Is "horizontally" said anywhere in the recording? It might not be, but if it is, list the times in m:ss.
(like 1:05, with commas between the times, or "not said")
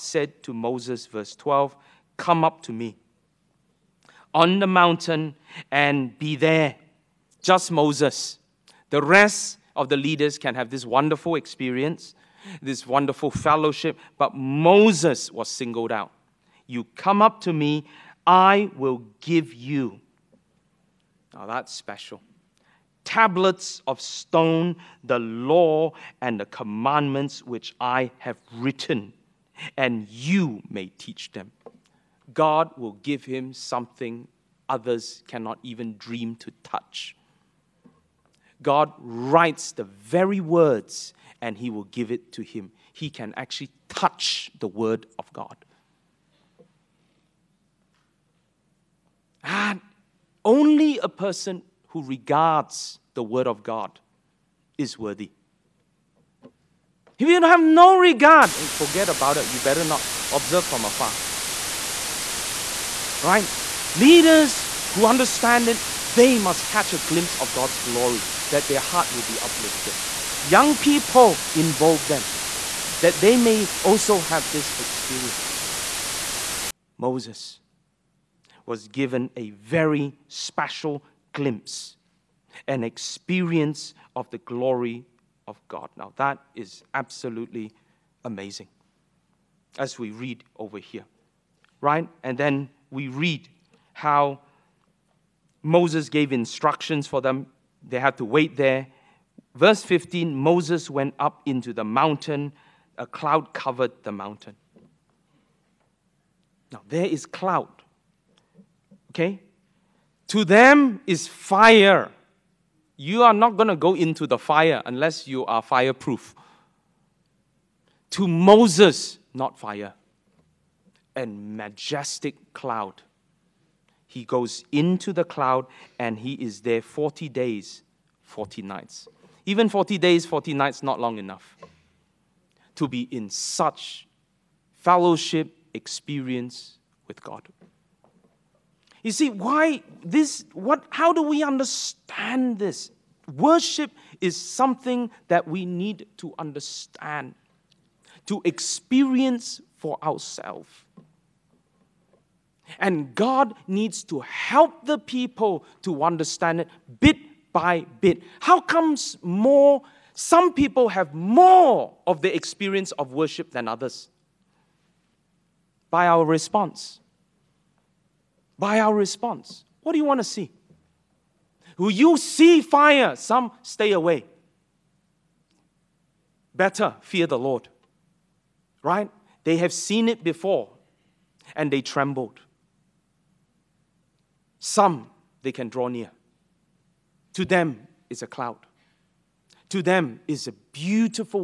not said.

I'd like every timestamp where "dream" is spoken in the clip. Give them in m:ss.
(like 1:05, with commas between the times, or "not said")
0:35.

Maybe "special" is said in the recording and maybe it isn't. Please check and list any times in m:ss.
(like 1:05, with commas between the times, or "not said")
0:21, 1:20.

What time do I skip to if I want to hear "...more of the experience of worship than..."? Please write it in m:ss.
2:41.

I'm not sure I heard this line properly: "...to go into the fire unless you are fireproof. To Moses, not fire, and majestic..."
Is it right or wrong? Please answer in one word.
right.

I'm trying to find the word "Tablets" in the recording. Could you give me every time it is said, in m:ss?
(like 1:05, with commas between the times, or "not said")
0:23.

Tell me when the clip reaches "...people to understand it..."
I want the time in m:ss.
2:34.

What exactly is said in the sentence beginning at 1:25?
Now, that is absolutely amazing as we read over here, right?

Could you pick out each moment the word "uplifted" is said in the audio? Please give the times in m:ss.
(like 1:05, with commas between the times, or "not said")
1:09.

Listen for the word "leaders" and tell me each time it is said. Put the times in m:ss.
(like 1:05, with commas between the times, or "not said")
0:09, 1:03.